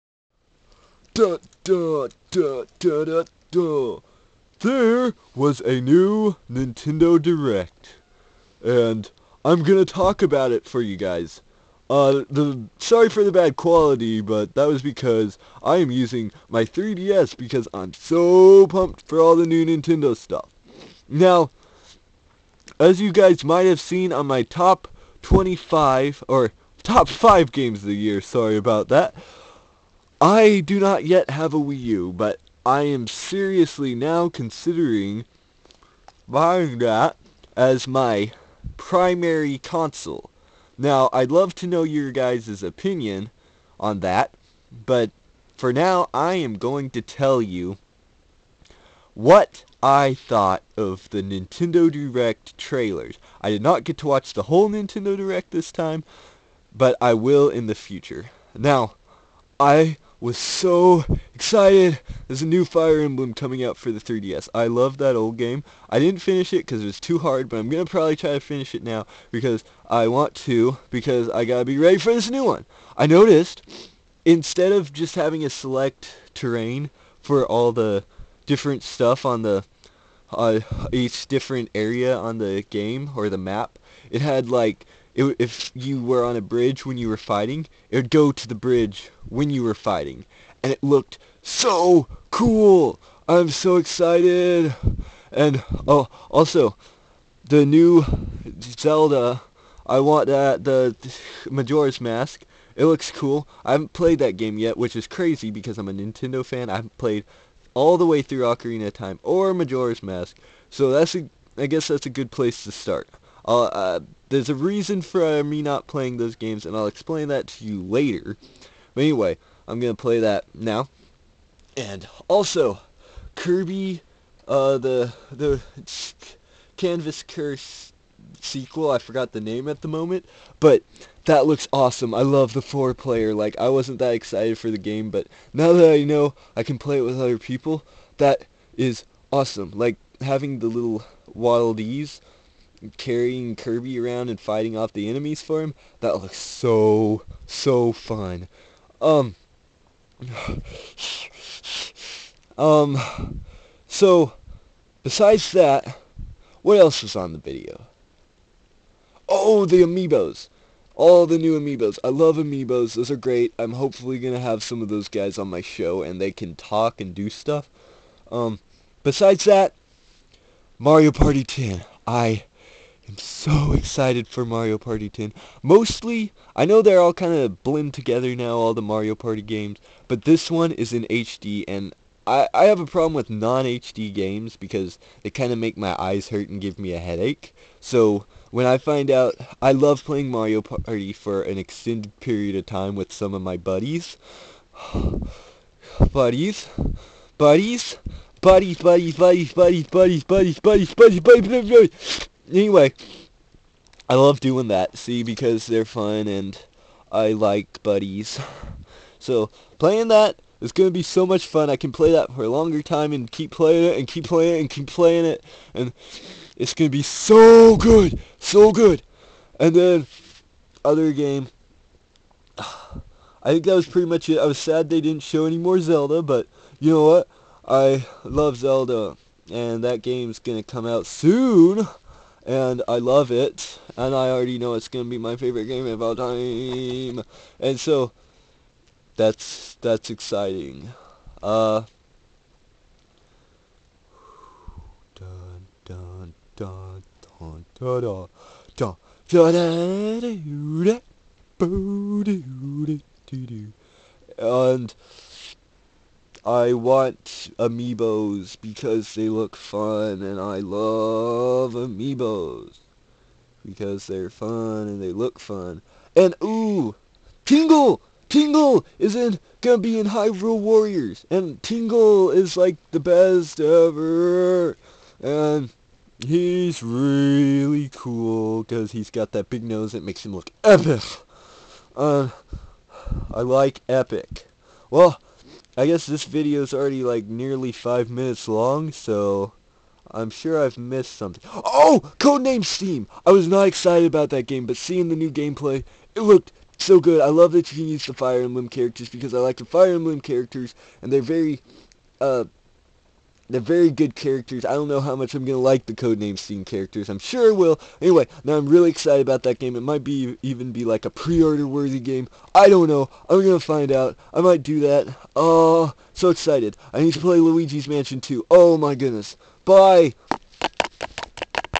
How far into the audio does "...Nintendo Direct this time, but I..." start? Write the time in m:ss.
0:54.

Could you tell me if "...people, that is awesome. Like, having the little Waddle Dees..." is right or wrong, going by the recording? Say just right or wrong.
right.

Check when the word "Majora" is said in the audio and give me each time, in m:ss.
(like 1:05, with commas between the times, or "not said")
1:41, 1:49.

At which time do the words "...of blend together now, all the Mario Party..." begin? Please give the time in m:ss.
2:57.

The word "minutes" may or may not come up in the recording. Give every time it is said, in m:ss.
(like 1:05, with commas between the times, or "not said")
4:48.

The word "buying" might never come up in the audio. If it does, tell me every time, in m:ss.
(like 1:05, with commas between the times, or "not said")
0:36.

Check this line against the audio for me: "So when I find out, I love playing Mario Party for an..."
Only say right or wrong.
right.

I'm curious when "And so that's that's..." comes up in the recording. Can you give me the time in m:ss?
3:57.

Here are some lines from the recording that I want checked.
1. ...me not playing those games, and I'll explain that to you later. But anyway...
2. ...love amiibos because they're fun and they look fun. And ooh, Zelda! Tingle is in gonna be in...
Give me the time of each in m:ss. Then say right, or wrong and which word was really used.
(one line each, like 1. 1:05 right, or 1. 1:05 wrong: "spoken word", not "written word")
1. 1:55 right
2. 4:20 wrong: "Tingle", not "Zelda".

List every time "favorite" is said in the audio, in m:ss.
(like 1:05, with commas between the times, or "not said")
3:55.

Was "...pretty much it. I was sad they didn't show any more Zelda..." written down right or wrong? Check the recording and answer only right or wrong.
right.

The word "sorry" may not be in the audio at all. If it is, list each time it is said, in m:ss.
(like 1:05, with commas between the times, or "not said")
0:12, 0:28.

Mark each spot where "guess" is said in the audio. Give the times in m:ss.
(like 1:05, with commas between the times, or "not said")
1:51, 4:45.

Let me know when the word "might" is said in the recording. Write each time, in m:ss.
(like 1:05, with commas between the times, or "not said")
0:23, 5:09, 5:14.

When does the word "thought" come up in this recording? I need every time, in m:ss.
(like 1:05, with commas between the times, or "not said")
0:50.